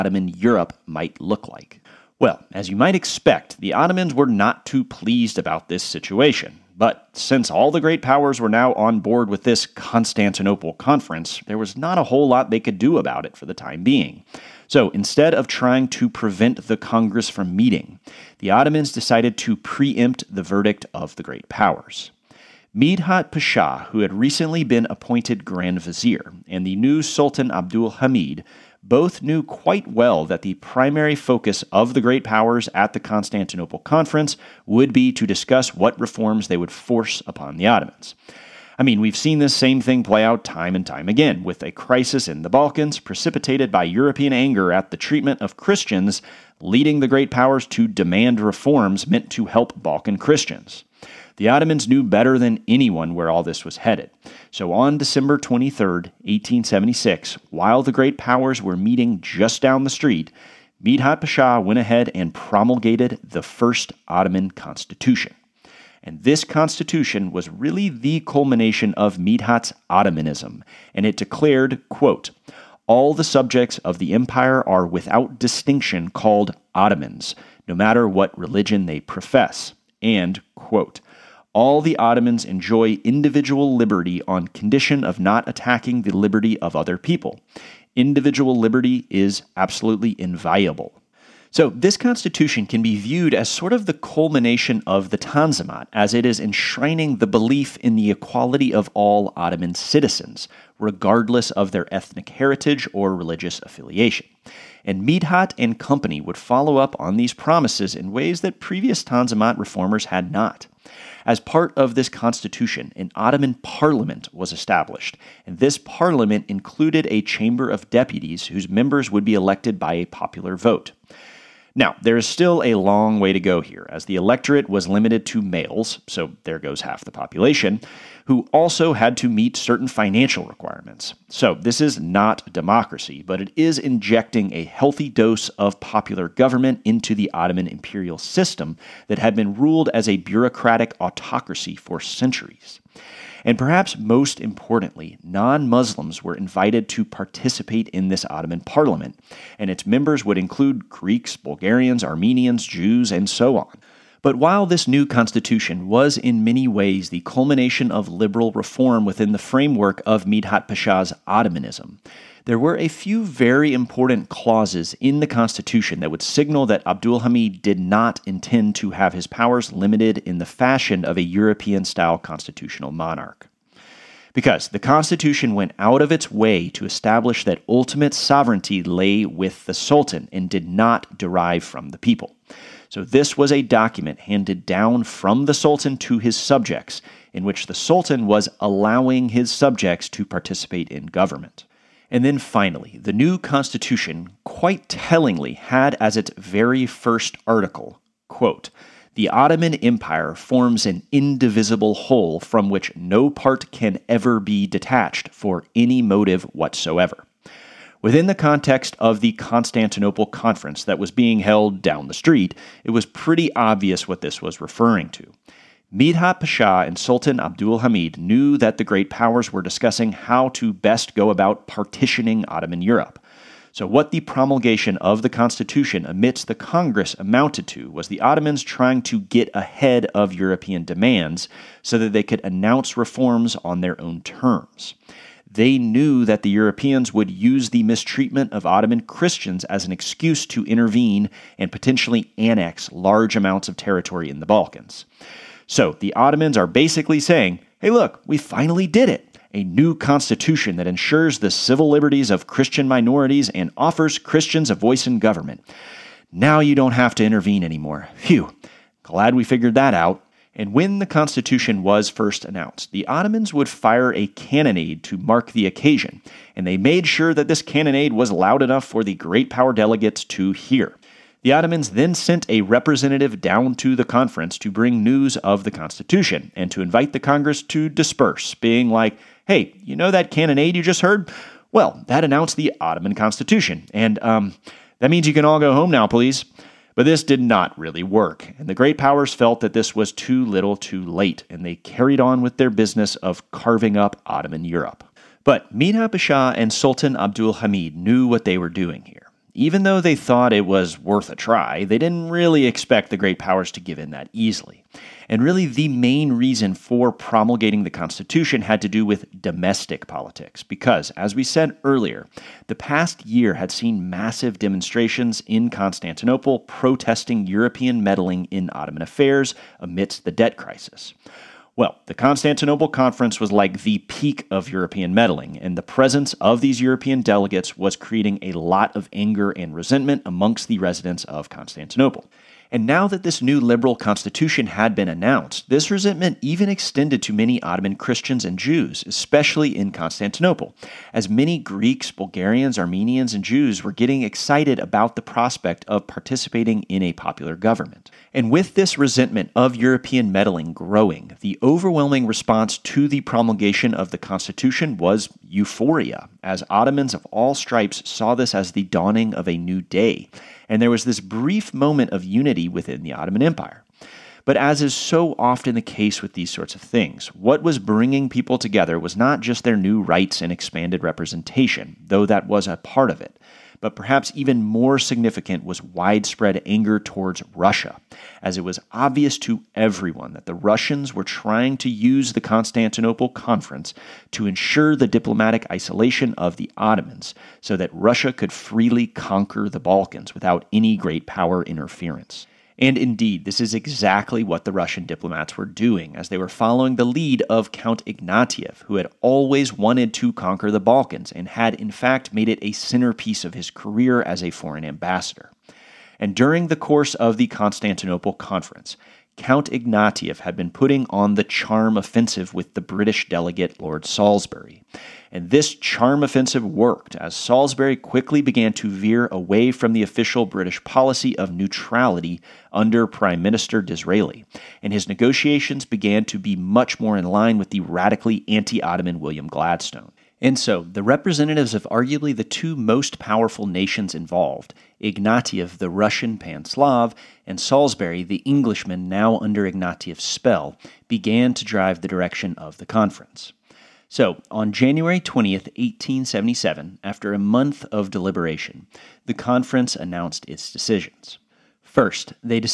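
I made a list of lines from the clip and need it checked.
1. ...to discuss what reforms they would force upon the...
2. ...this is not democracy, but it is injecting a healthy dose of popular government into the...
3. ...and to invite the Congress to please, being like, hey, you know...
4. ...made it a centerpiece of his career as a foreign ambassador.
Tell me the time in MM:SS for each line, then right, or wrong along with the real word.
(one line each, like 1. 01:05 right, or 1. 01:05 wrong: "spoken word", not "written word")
1. 00:35 right
2. 02:11 right
3. 04:36 wrong: "disperse", not "please"
4. 06:42 right.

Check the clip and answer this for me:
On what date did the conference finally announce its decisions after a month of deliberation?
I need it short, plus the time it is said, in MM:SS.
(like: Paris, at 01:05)
January 20, 1877, at 07:24.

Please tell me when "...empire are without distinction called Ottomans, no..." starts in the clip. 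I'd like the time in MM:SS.
01:14.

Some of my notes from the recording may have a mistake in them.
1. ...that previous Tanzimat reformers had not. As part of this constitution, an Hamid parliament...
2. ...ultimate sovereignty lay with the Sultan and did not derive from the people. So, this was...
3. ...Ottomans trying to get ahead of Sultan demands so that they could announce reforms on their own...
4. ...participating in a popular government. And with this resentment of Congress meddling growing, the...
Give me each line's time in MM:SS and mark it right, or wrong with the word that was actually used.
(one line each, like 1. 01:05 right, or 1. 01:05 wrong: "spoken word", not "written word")
1. 01:48 wrong: "Ottoman", not "Hamid"
2. 02:57 right
3. 03:48 wrong: "European", not "Sultan"
4. 05:46 wrong: "European", not "Congress".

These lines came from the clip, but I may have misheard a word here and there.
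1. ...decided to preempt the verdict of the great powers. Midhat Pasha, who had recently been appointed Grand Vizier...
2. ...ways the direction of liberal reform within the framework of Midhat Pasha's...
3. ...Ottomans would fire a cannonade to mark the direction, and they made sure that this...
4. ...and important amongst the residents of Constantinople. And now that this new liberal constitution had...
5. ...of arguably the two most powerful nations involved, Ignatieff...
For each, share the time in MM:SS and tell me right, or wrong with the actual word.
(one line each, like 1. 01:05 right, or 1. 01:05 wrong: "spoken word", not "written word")
1. 00:18 right
2. 02:36 wrong: "culmination", not "direction"
3. 04:23 wrong: "occasion", not "direction"
4. 05:29 wrong: "resentment", not "important"
5. 07:11 right.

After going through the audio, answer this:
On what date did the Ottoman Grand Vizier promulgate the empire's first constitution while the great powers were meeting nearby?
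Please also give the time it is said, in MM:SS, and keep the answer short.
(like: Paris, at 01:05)
December 23, 1876, at 00:54.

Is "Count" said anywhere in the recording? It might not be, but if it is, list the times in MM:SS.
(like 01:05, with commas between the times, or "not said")
06:37, 06:49.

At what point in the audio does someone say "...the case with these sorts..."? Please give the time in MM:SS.
06:05.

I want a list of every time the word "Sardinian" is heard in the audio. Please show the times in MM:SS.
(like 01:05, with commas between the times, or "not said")
not said.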